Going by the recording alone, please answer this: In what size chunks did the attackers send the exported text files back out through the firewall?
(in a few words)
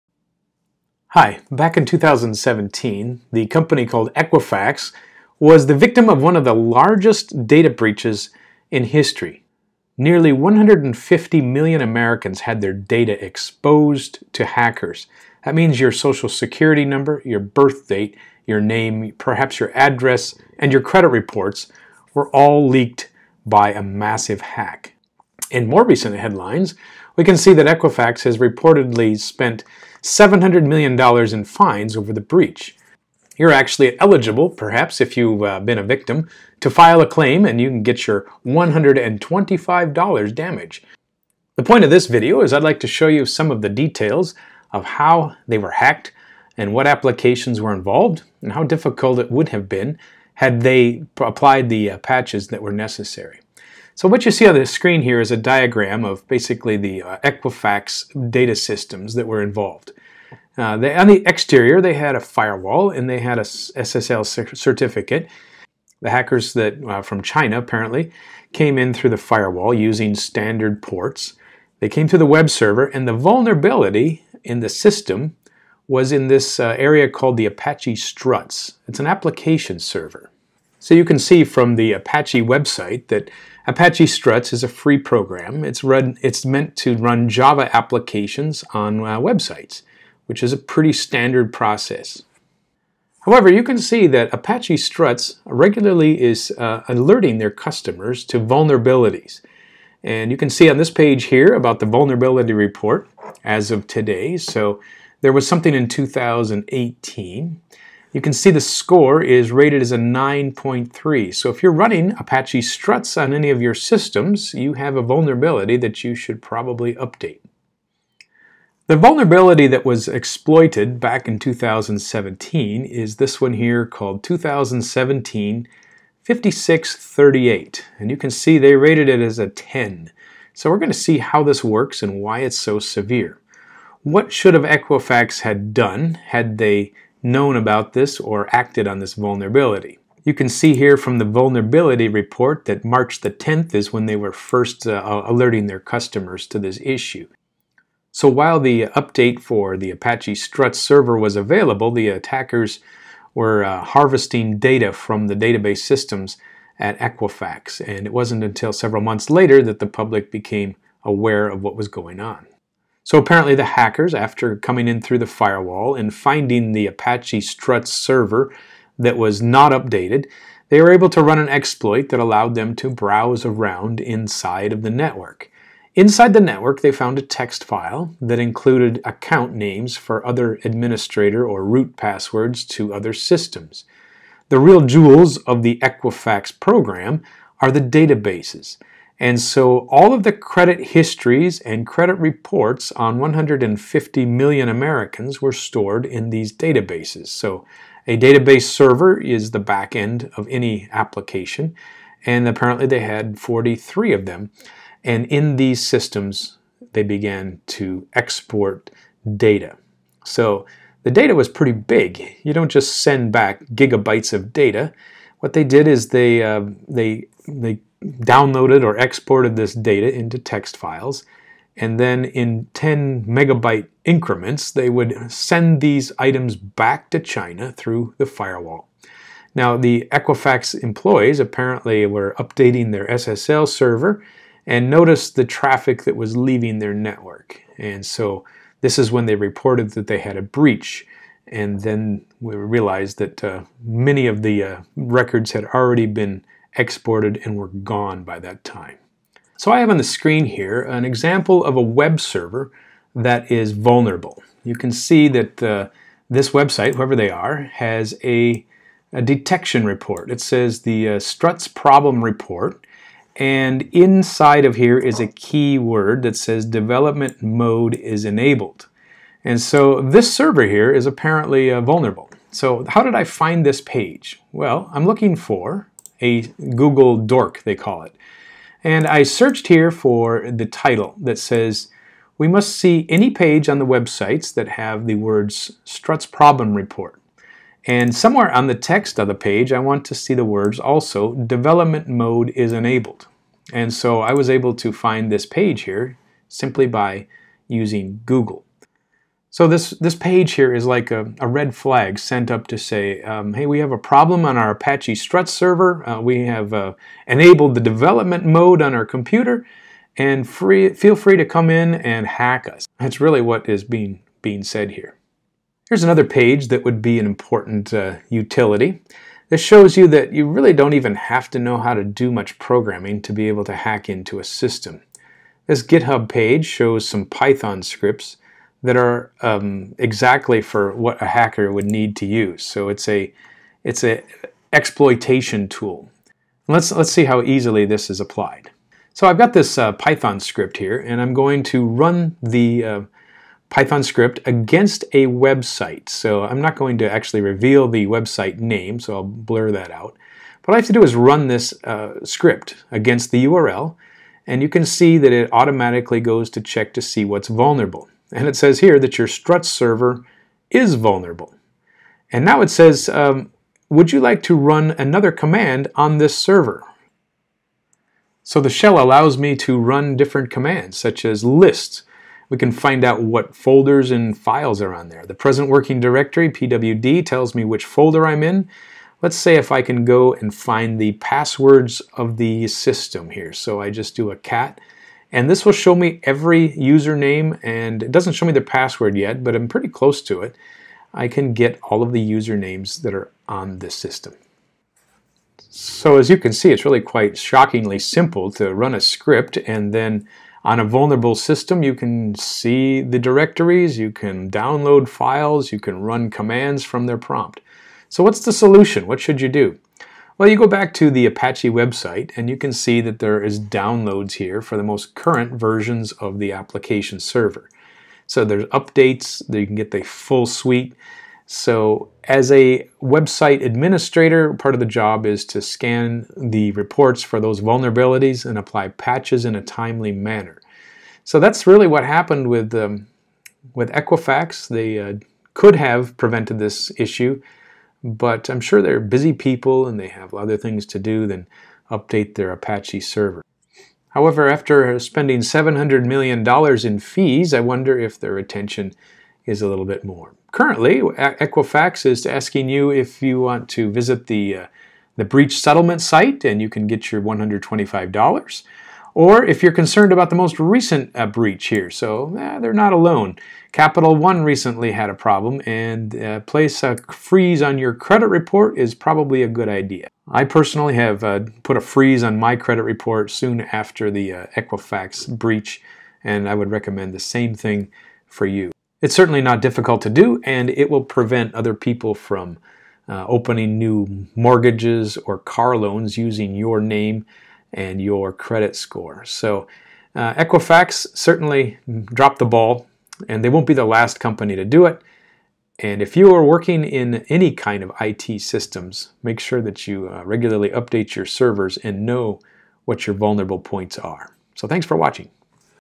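10 megabytes.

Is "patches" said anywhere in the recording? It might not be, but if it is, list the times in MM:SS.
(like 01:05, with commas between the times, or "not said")
00:51, 07:08.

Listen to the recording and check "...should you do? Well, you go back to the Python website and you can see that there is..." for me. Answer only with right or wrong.
wrong.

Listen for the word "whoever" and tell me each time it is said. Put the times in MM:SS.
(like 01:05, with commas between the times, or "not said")
04:16.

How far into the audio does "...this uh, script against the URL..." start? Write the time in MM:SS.
05:51.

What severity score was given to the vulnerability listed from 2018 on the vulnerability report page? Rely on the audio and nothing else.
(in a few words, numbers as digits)
9.3.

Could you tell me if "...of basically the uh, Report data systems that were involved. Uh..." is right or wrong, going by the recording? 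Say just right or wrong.
wrong.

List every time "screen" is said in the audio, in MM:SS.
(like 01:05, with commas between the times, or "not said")
00:54, 04:10.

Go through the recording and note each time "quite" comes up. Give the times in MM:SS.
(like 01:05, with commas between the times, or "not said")
06:37.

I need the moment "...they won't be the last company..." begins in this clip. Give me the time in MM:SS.
08:13.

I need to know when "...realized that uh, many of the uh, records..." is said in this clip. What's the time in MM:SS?
04:02.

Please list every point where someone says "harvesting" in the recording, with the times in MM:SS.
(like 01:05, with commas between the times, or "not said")
02:33.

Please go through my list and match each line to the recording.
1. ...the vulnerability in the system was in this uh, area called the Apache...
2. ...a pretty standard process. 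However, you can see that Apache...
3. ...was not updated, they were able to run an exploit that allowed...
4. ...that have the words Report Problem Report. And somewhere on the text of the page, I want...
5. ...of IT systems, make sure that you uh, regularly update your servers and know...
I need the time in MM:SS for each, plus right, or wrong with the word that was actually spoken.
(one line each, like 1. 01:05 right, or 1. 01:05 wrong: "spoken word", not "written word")
1. 01:13 right
2. 01:30 right
3. 02:49 right
4. 04:44 wrong: "Struts", not "Report"
5. 08:17 right.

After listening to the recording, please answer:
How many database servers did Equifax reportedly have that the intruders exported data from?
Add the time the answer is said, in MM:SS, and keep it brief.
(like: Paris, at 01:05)
43, at 03:23.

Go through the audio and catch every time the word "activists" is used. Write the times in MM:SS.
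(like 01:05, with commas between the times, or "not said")
not said.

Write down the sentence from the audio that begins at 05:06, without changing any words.
Uh, we have uh, enabled the development mode on our computer, and free, feel free to come in and hack us.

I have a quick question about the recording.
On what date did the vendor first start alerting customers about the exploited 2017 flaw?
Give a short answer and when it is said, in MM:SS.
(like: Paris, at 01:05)
March 10, at 02:22.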